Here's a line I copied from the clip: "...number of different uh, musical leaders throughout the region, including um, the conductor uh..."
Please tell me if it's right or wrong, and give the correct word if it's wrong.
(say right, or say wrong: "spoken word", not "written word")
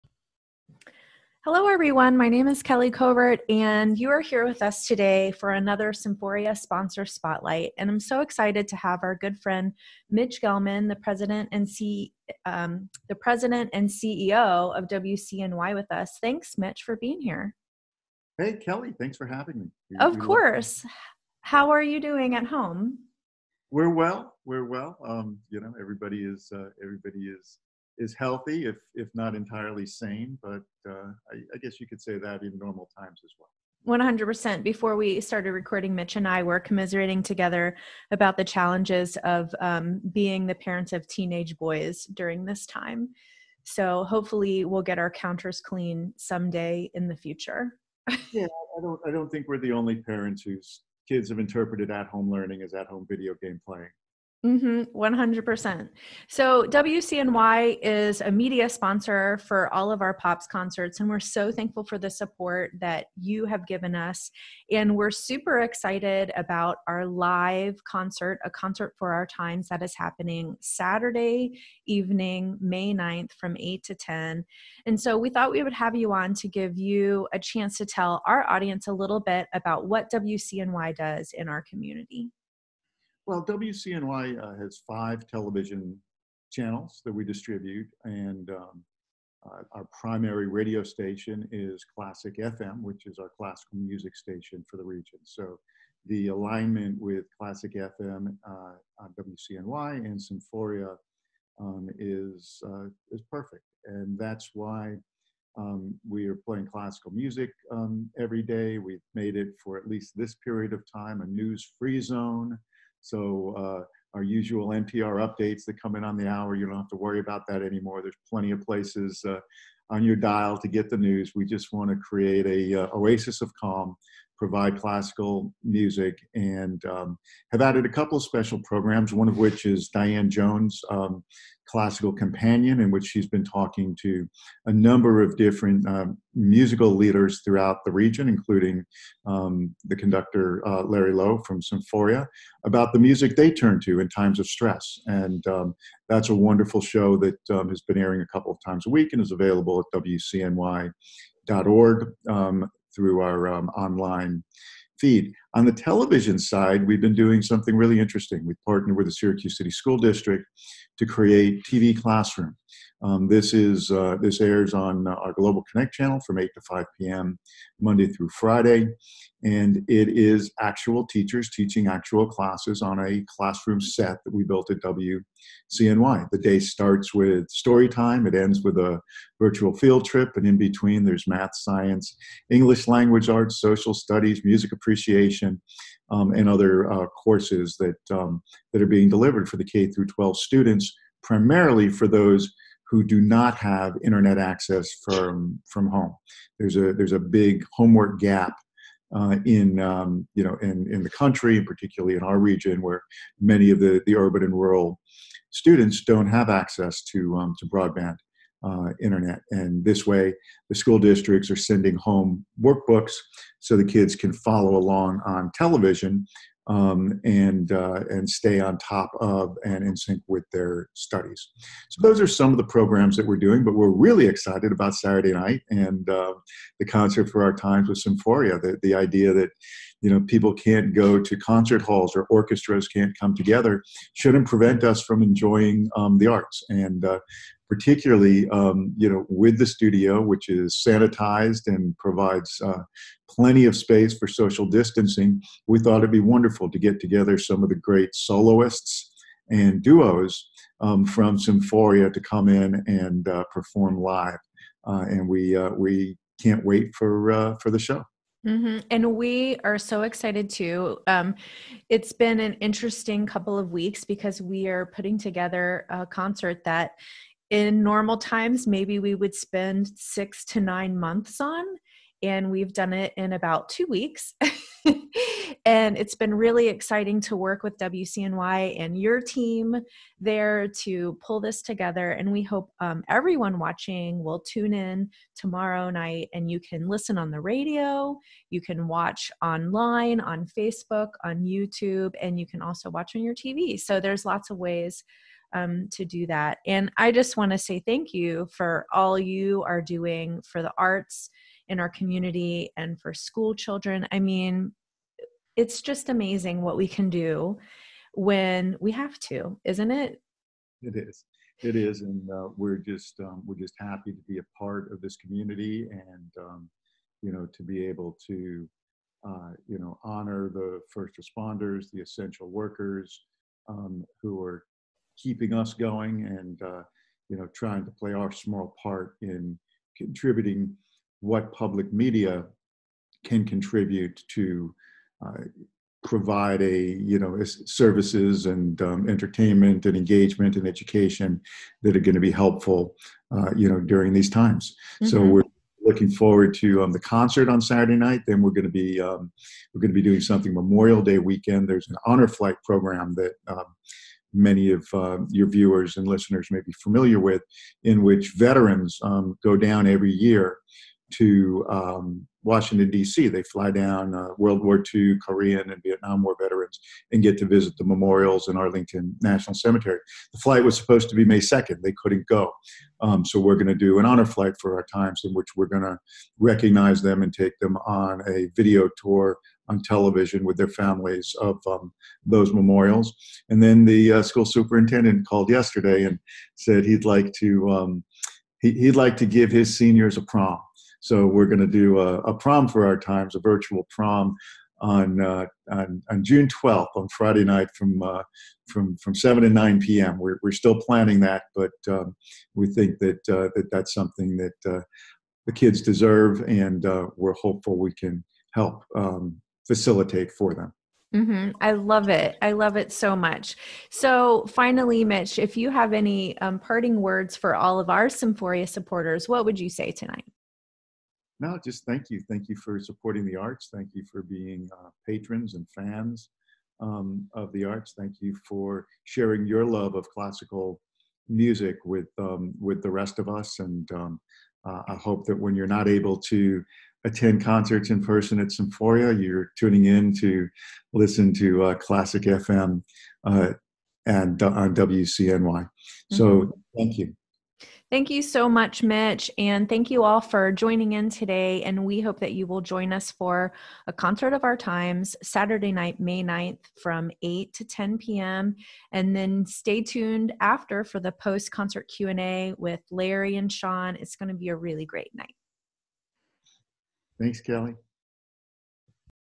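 right.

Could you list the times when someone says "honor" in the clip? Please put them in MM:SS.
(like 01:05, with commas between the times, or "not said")
05:20, 05:52, 06:14.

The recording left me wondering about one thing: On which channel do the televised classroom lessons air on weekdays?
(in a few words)
Global Connect.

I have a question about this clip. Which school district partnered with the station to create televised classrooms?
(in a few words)
Syracuse City School District.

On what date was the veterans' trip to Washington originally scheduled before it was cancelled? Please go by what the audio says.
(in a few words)
May 2nd.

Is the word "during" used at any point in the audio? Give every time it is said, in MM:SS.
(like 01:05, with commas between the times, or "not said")
00:42, 05:43.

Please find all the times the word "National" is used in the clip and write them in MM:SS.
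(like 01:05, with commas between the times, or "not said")
06:09.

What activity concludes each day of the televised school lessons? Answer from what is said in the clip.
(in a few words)
virtual field trip.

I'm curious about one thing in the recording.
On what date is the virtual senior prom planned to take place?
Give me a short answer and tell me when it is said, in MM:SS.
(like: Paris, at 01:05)
June 12th, at 06:36.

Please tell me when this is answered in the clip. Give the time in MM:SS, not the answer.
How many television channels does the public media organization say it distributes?
01:24.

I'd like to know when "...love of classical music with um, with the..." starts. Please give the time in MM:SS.
07:09.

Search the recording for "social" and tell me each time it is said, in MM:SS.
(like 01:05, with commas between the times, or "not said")
03:03, 04:04.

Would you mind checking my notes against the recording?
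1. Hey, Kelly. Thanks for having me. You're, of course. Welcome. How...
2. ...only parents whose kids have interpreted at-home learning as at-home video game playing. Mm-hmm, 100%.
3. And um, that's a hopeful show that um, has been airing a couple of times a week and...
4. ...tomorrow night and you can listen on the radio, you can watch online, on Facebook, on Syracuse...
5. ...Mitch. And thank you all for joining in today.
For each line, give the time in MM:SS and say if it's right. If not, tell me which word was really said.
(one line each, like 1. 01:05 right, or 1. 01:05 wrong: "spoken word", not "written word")
1. 00:18 right
2. 00:49 right
3. 02:25 wrong: "wonderful", not "hopeful"
4. 04:45 wrong: "YouTube", not "Syracuse"
5. 07:28 right.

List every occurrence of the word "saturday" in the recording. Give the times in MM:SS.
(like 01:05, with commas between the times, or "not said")
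01:10, 03:44, 05:47, 07:35.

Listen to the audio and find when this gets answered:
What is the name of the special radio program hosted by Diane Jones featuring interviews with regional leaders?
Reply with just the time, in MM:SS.
02:11.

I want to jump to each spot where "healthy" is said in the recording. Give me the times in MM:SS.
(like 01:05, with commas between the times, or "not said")
00:28.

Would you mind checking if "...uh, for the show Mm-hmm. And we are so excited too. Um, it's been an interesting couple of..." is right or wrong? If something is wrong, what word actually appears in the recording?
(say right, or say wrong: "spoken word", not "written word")
right.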